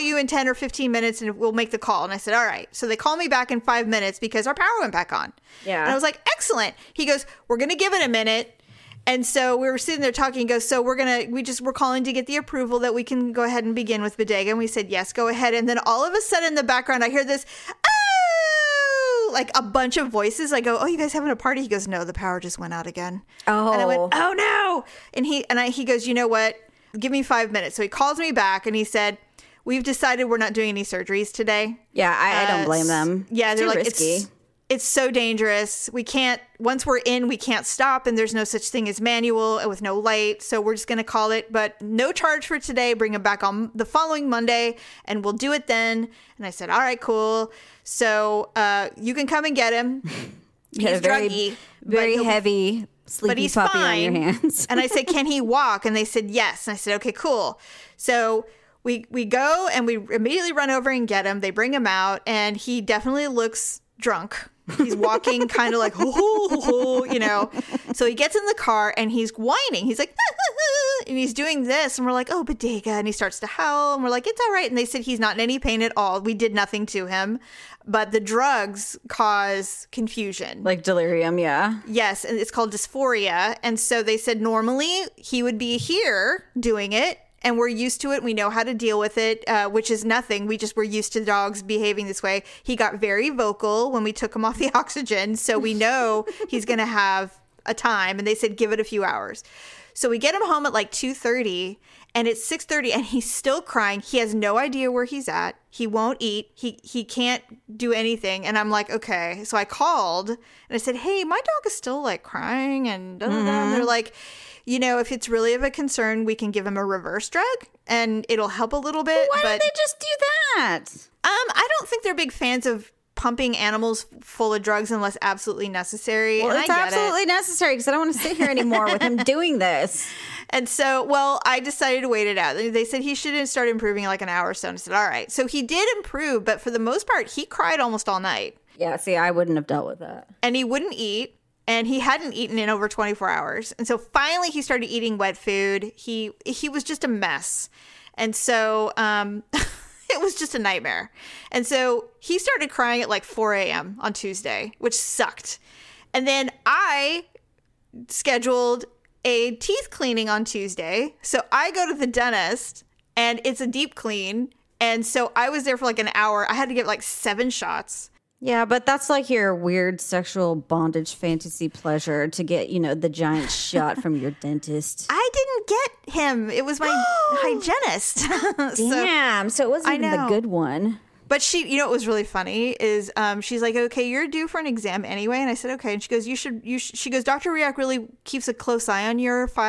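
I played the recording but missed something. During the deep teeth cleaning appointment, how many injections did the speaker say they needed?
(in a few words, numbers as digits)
7.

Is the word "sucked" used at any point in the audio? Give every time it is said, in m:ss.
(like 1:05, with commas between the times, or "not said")
2:34.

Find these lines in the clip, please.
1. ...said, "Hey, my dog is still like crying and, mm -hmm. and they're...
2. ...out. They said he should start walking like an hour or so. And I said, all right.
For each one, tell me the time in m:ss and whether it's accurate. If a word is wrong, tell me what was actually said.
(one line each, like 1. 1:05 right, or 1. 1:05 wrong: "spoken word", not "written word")
1. 1:50 right
2. 2:12 wrong: "improving", not "walking".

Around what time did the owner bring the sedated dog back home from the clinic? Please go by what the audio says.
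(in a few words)
2:30.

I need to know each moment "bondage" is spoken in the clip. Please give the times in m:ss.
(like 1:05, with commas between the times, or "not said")
2:50.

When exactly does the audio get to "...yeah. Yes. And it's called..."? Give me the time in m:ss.
1:21.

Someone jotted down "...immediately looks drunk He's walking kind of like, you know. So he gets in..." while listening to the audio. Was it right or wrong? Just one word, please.
wrong.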